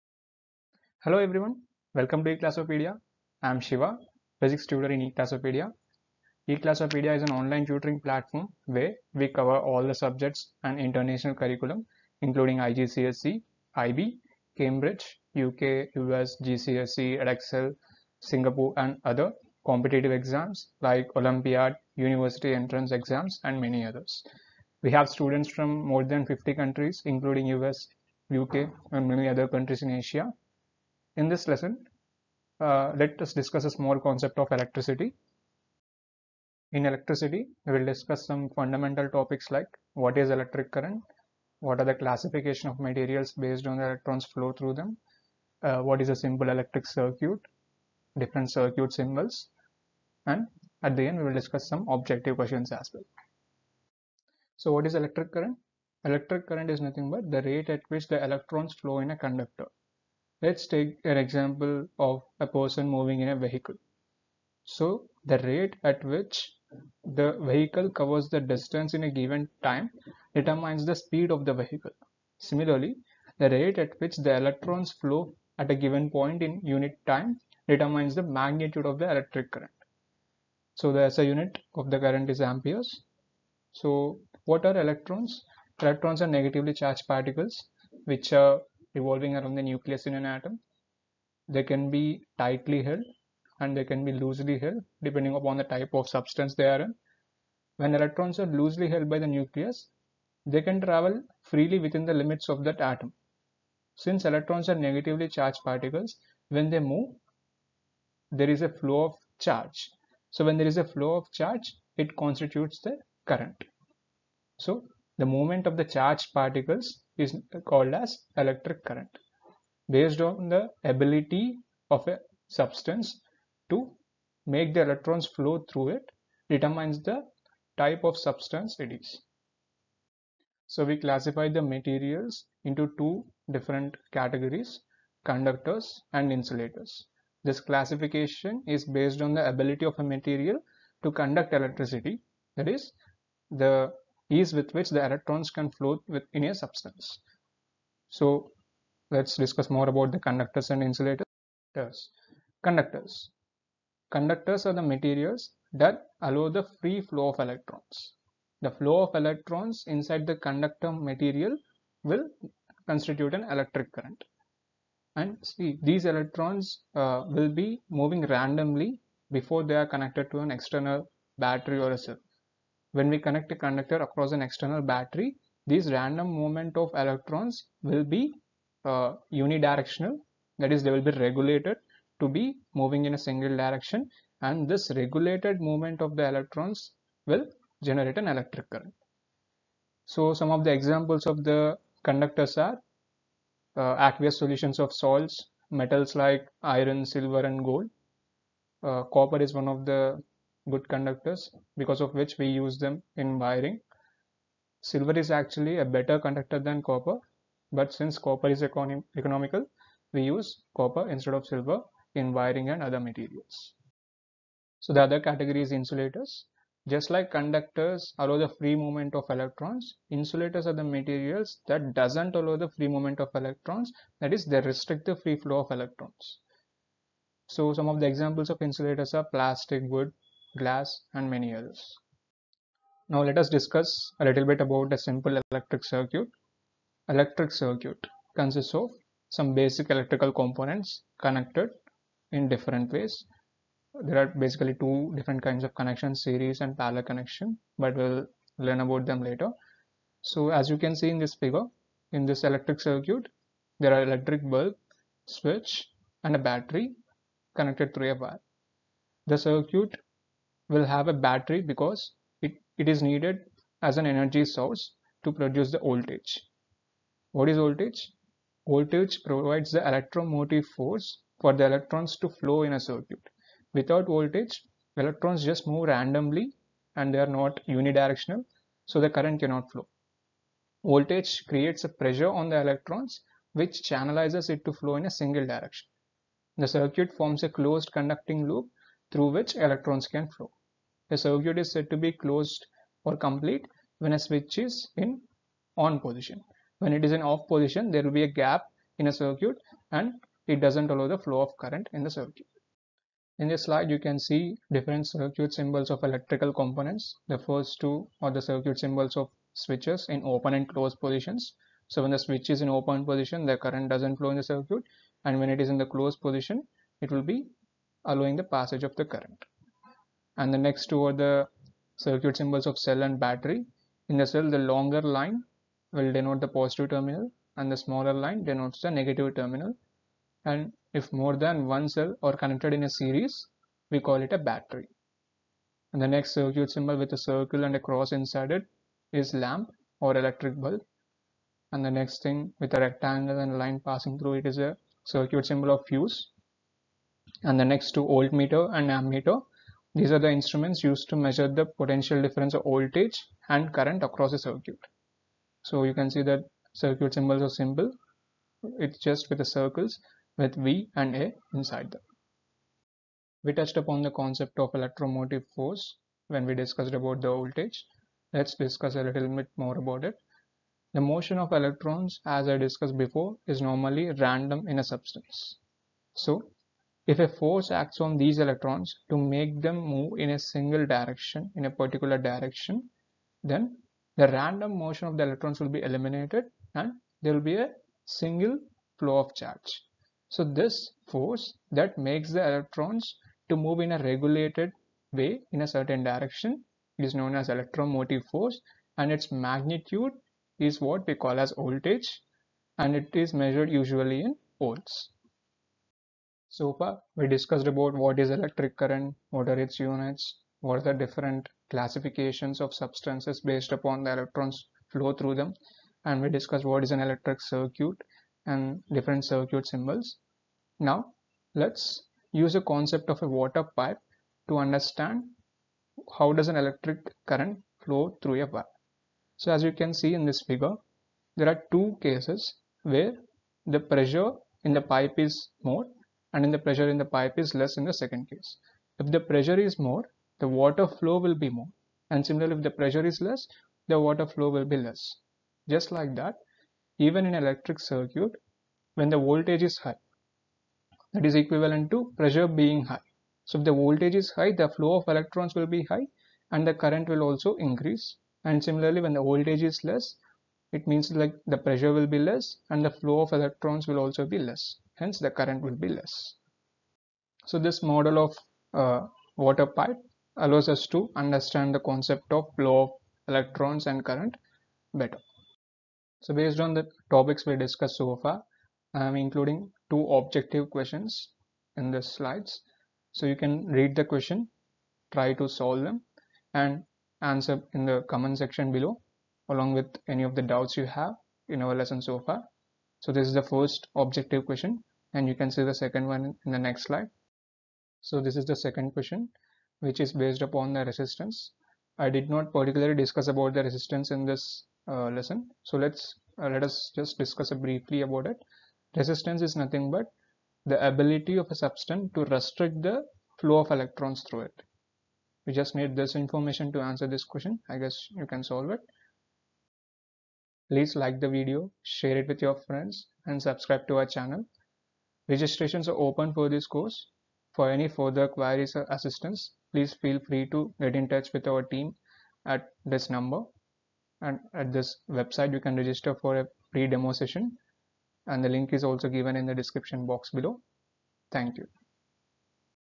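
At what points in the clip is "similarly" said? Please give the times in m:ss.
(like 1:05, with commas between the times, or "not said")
1:12, 7:22, 7:38.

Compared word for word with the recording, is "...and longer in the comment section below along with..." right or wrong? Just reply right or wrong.
wrong.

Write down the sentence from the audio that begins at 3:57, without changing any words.
Electric circuit consists of some basic electrical components connected in different ways.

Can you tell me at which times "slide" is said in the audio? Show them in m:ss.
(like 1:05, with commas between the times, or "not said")
5:03, 8:02, 8:16.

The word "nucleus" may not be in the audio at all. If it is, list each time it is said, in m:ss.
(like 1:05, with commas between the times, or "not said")
1:29, 1:39.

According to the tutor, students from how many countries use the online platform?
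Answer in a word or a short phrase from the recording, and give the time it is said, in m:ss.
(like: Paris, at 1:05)
50, at 0:26.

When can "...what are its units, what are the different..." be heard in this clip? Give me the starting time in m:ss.
6:49.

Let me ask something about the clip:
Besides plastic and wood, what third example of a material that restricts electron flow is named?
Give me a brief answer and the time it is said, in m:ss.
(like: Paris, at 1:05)
Glass, at 3:50.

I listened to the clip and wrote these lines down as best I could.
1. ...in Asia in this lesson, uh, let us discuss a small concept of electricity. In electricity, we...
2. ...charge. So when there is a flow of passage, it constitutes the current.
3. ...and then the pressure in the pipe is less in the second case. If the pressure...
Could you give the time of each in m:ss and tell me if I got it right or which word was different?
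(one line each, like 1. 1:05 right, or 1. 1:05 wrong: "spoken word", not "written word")
1. 0:29 right
2. 1:49 wrong: "charge", not "passage"
3. 7:16 right.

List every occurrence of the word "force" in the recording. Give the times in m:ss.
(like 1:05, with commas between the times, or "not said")
4:30, 6:05, 6:17, 6:31, 6:38.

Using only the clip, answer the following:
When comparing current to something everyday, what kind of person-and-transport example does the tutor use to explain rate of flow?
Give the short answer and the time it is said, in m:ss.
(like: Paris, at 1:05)
a person moving in a vehicle, at 1:02.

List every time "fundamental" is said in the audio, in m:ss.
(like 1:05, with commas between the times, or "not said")
0:38.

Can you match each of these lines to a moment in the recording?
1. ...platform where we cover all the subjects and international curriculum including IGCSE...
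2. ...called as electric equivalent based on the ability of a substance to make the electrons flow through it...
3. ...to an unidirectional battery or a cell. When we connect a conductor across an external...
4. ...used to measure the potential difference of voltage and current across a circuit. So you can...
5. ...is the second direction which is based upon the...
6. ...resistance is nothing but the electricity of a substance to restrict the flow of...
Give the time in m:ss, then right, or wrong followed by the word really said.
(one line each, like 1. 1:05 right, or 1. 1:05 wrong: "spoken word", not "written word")
1. 0:07 right
2. 1:57 wrong: "current", not "equivalent"
3. 2:50 wrong: "external", not "unidirectional"
4. 5:50 right
5. 8:18 wrong: "question", not "direction"
6. 8:28 wrong: "ability", not "electricity".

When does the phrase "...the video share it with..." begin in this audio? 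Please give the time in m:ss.
8:41.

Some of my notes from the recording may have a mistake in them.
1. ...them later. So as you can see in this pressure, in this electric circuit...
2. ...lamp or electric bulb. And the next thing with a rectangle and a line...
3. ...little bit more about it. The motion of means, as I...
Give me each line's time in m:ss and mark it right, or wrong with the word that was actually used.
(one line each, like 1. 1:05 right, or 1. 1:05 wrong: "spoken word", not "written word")
1. 4:09 wrong: "figure", not "pressure"
2. 5:39 right
3. 6:09 wrong: "electrons", not "means".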